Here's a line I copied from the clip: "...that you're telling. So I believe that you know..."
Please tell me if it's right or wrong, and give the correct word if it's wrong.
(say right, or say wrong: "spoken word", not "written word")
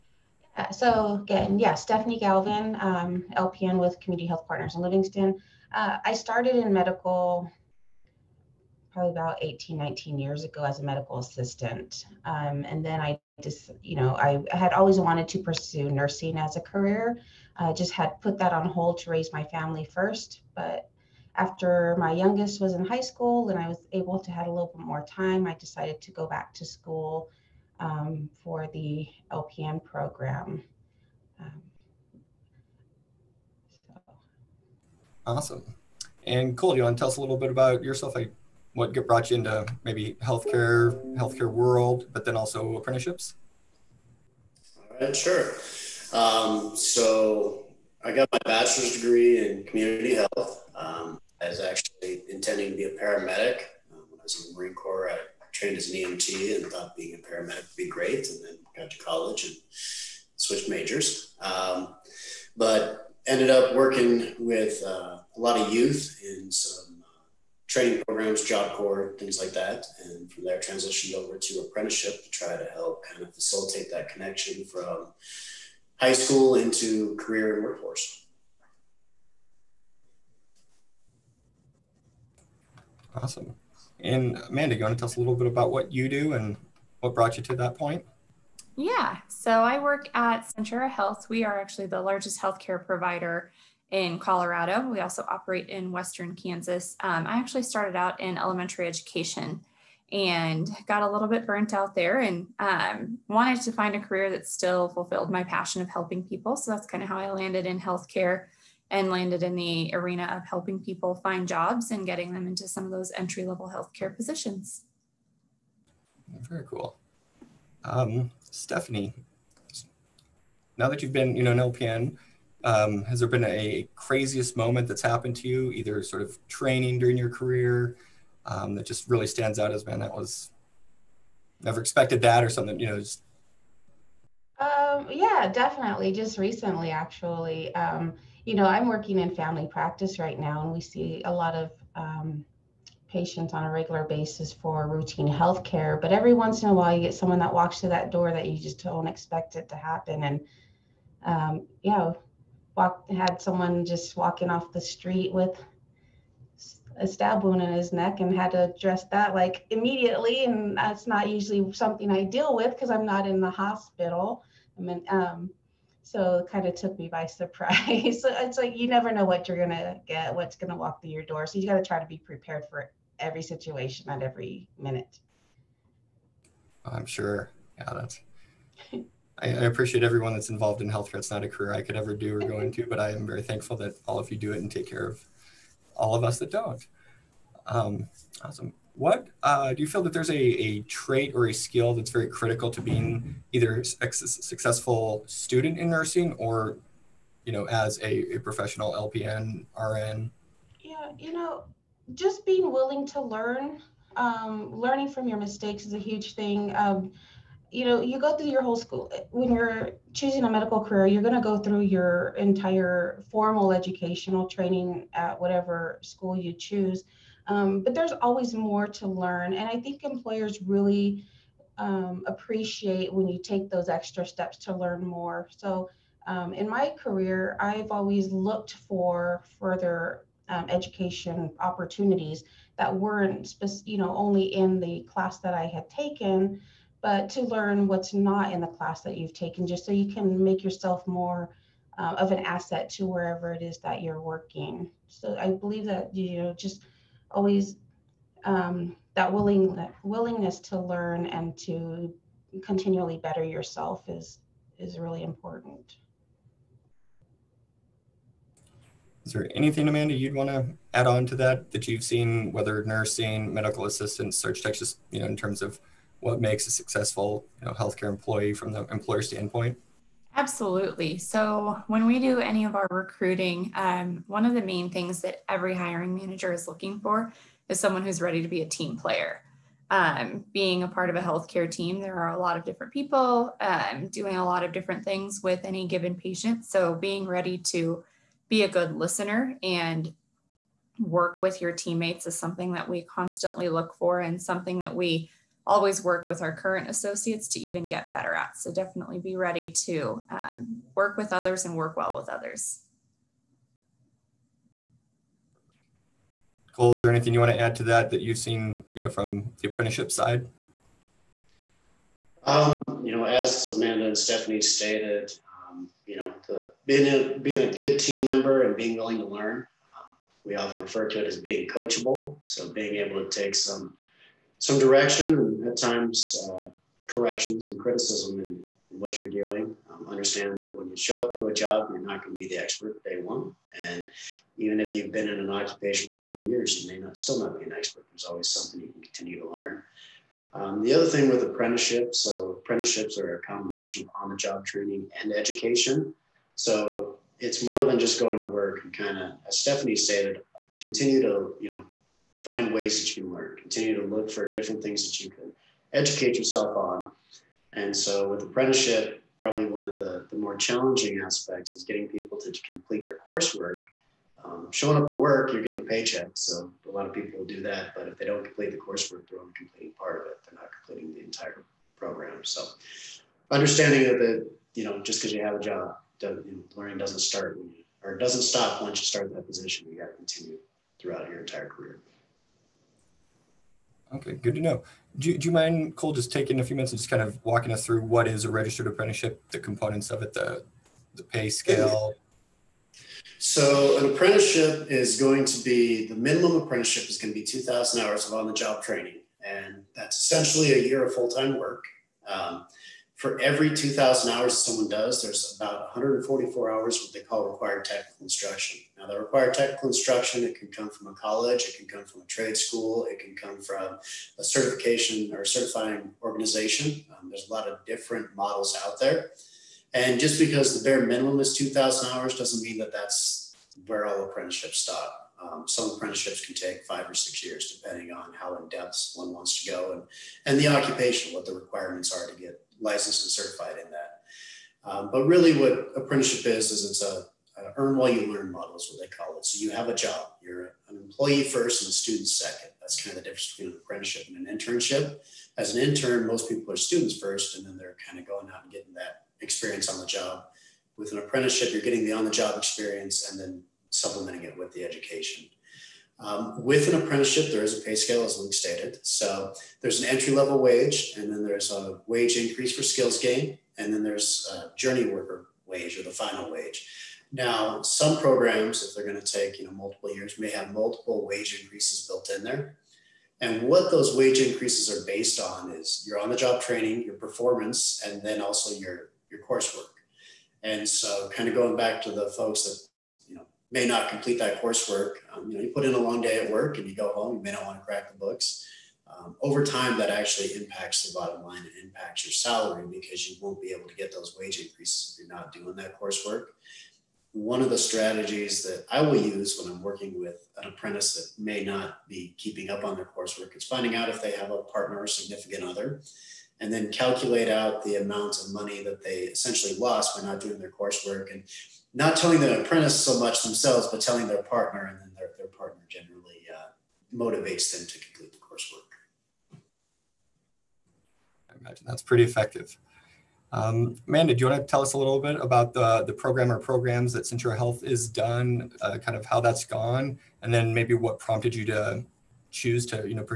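wrong: "working", not "telling".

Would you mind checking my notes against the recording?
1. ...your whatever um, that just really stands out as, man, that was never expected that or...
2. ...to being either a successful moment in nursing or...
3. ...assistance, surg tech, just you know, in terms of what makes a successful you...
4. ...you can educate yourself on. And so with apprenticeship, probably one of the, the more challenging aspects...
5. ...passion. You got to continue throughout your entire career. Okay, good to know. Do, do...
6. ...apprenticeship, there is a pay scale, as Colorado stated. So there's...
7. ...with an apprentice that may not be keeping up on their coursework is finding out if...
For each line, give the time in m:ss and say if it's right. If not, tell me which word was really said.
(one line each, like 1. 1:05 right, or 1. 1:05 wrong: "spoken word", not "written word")
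1. 2:07 wrong: "career", not "whatever"
2. 3:12 wrong: "student", not "moment"
3. 4:23 right
4. 5:55 right
5. 6:19 wrong: "position", not "passion"
6. 7:37 wrong: "Luke", not "Colorado"
7. 8:20 right.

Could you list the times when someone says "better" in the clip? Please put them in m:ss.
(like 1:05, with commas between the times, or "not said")
4:13, 4:58.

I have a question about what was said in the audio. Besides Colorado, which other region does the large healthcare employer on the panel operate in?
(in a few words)
Western Kansas.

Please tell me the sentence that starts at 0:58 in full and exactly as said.
And then got to college and switched majors.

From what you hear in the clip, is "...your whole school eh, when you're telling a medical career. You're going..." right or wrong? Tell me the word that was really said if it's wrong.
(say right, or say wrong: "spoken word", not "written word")
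wrong: "choosing", not "telling".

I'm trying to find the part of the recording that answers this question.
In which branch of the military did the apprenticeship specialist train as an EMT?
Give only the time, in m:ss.
0:54.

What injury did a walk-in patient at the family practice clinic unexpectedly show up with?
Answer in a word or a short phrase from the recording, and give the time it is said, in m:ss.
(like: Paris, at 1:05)
stab wound, at 2:37.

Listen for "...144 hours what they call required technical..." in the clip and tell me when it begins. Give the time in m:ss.
6:45.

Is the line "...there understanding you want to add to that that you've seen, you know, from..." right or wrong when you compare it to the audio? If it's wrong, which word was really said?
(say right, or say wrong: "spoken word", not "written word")
wrong: "anything", not "understanding".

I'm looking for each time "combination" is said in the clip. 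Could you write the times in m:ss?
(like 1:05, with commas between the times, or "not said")
5:43.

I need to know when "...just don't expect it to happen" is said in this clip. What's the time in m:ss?
2:28.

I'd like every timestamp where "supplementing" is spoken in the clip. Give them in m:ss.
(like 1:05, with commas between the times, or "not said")
7:33.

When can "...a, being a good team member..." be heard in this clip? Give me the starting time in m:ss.
5:17.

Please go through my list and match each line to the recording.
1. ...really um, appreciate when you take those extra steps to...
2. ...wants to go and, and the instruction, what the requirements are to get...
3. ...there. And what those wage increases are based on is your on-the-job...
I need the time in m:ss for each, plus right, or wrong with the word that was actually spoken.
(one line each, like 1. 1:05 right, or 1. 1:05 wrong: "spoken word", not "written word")
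1. 3:40 right
2. 7:09 wrong: "occupation", not "instruction"
3. 7:52 right.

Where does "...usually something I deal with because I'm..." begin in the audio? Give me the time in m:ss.
2:41.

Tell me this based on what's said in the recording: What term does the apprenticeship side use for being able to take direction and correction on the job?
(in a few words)
coachable.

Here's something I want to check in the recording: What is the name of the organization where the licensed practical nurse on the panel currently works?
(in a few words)
Community Health Partners.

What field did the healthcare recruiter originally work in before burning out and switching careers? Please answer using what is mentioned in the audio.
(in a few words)
elementary education.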